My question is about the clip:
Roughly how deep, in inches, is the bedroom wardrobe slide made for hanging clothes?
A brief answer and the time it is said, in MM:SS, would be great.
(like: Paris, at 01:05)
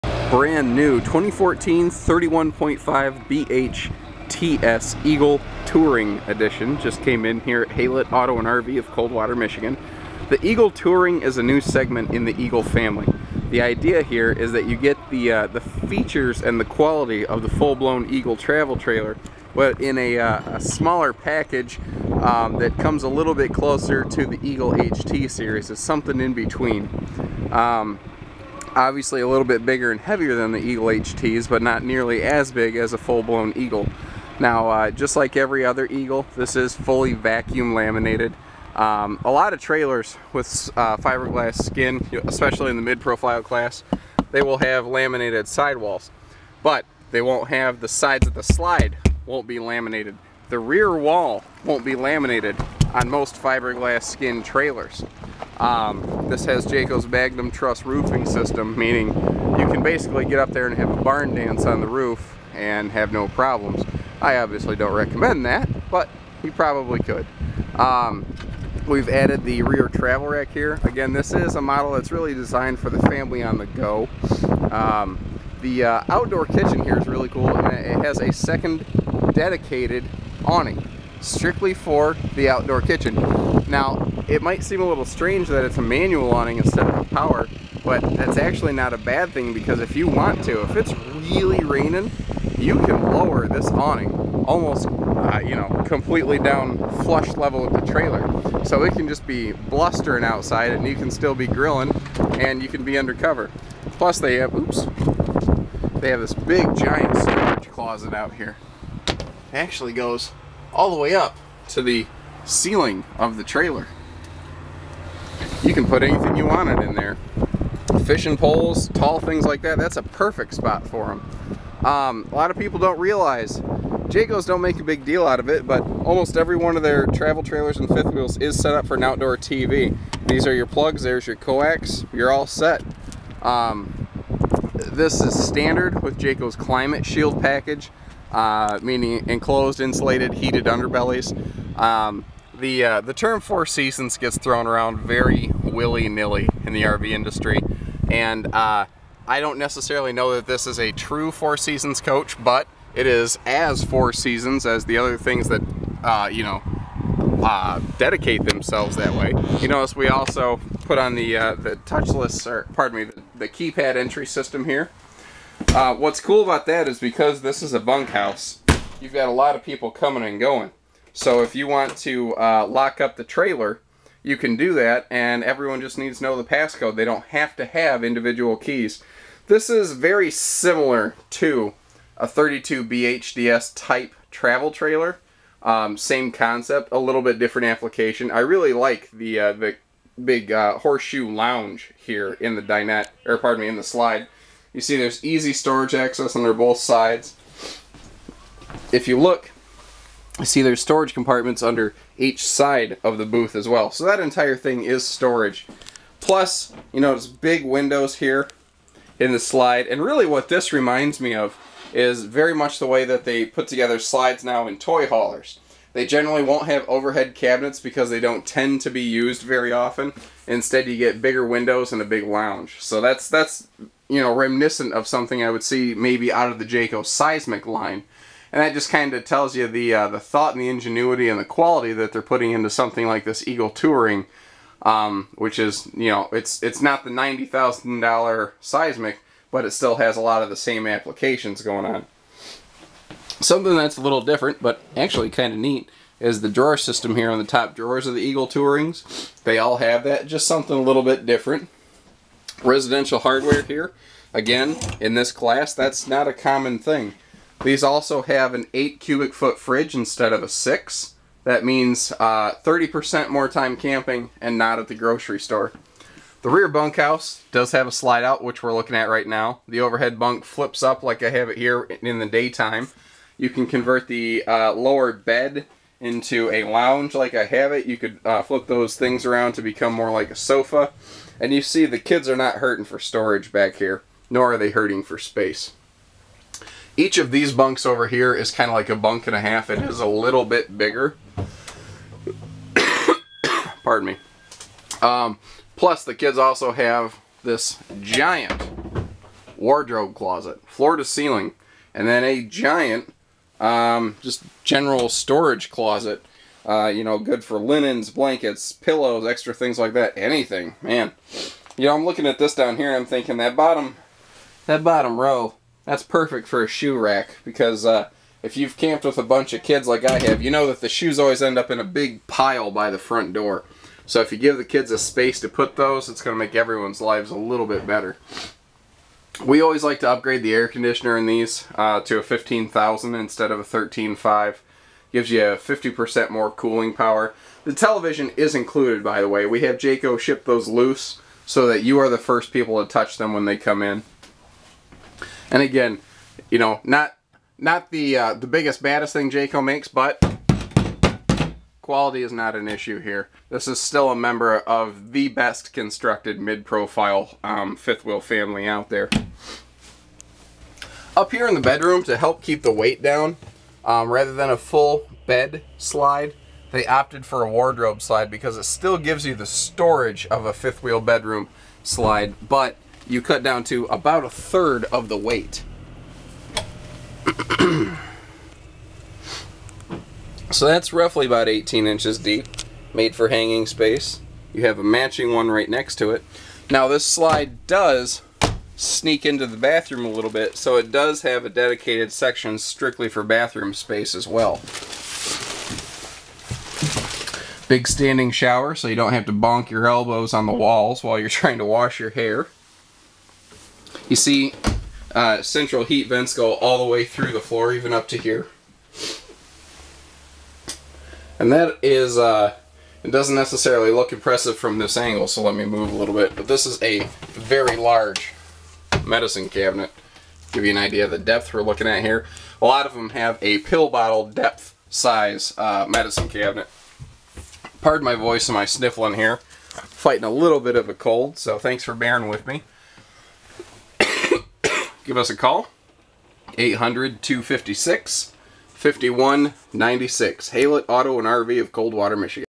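18 inches, at 06:21.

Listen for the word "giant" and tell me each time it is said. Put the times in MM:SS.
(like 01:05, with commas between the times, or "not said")
01:46, 04:58, 05:02.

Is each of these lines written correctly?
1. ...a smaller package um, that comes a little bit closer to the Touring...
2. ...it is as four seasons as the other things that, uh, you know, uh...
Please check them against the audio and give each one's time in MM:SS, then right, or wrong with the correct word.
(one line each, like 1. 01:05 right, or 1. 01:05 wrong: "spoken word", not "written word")
1. 00:20 wrong: "Eagle", not "Touring"
2. 02:32 right.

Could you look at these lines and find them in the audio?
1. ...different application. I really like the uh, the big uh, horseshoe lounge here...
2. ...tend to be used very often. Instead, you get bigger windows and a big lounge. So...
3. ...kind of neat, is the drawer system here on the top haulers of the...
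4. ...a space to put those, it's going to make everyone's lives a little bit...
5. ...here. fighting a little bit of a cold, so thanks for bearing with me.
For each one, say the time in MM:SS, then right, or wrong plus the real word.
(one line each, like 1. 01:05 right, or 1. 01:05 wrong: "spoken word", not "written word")
1. 03:07 right
2. 03:38 right
3. 04:05 wrong: "drawers", not "haulers"
4. 05:24 right
5. 07:09 right.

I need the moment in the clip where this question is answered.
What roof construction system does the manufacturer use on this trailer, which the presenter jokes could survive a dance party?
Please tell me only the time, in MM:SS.
00:57.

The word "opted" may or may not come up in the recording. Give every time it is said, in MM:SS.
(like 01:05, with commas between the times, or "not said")
06:06.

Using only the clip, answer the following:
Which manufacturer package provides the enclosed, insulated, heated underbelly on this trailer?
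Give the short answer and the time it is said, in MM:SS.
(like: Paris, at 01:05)
Climate Shield, at 02:16.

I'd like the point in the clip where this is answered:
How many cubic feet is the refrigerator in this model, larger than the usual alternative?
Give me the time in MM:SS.
04:18.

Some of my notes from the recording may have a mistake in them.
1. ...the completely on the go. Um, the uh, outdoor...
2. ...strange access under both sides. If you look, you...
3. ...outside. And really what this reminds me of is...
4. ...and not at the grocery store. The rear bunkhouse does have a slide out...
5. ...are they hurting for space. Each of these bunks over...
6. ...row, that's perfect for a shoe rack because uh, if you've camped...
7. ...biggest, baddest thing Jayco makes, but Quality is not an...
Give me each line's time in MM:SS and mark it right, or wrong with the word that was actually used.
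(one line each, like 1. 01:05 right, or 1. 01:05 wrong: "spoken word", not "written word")
1. 01:12 wrong: "family", not "completely"
2. 03:15 wrong: "storage", not "strange"
3. 03:29 wrong: "slide", not "outside"
4. 04:24 right
5. 04:44 right
6. 05:15 right
7. 05:48 right.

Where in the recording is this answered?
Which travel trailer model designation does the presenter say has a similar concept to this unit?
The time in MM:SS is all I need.
03:02.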